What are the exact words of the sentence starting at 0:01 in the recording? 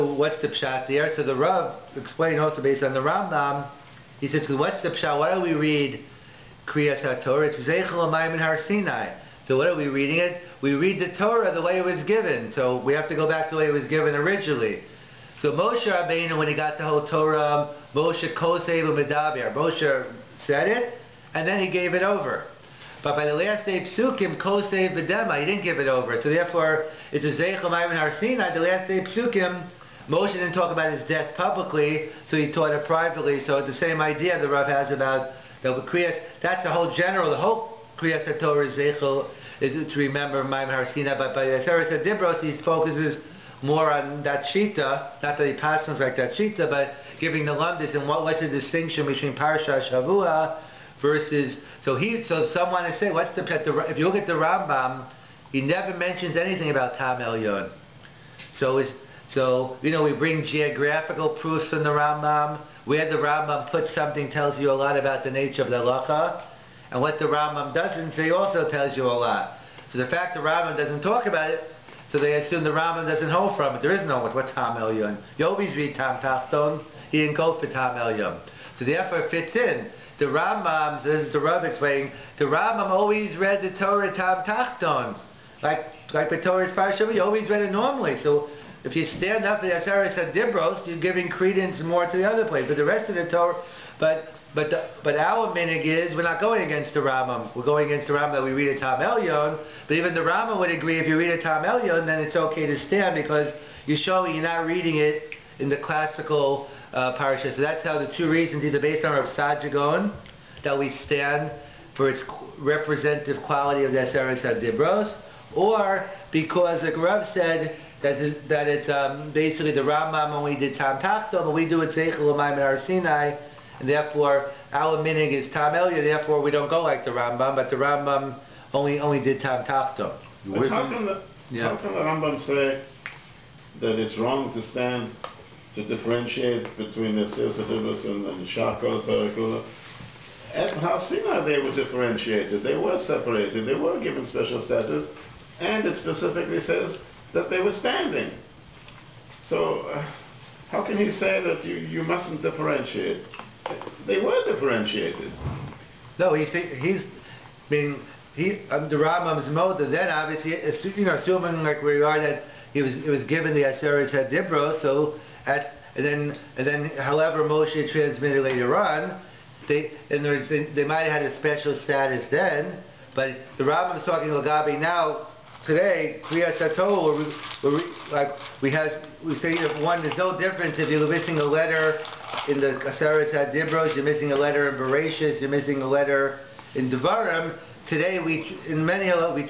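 So the Rav explained also based on the Rambam.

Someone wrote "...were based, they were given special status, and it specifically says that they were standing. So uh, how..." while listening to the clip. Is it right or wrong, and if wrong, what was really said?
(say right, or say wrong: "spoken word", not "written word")
wrong: "separated", not "based".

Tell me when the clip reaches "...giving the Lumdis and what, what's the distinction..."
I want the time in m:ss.
0:47.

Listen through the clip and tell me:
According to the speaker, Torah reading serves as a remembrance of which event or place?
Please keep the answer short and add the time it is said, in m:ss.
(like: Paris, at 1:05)
Har Sinai, at 0:08.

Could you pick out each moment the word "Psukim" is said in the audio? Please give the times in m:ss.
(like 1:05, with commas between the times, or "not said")
0:23, 0:28.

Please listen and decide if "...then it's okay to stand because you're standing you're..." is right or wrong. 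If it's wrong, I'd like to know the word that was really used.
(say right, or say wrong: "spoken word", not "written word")
wrong: "showing", not "standing".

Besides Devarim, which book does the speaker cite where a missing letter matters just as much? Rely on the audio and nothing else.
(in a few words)
Bereshis.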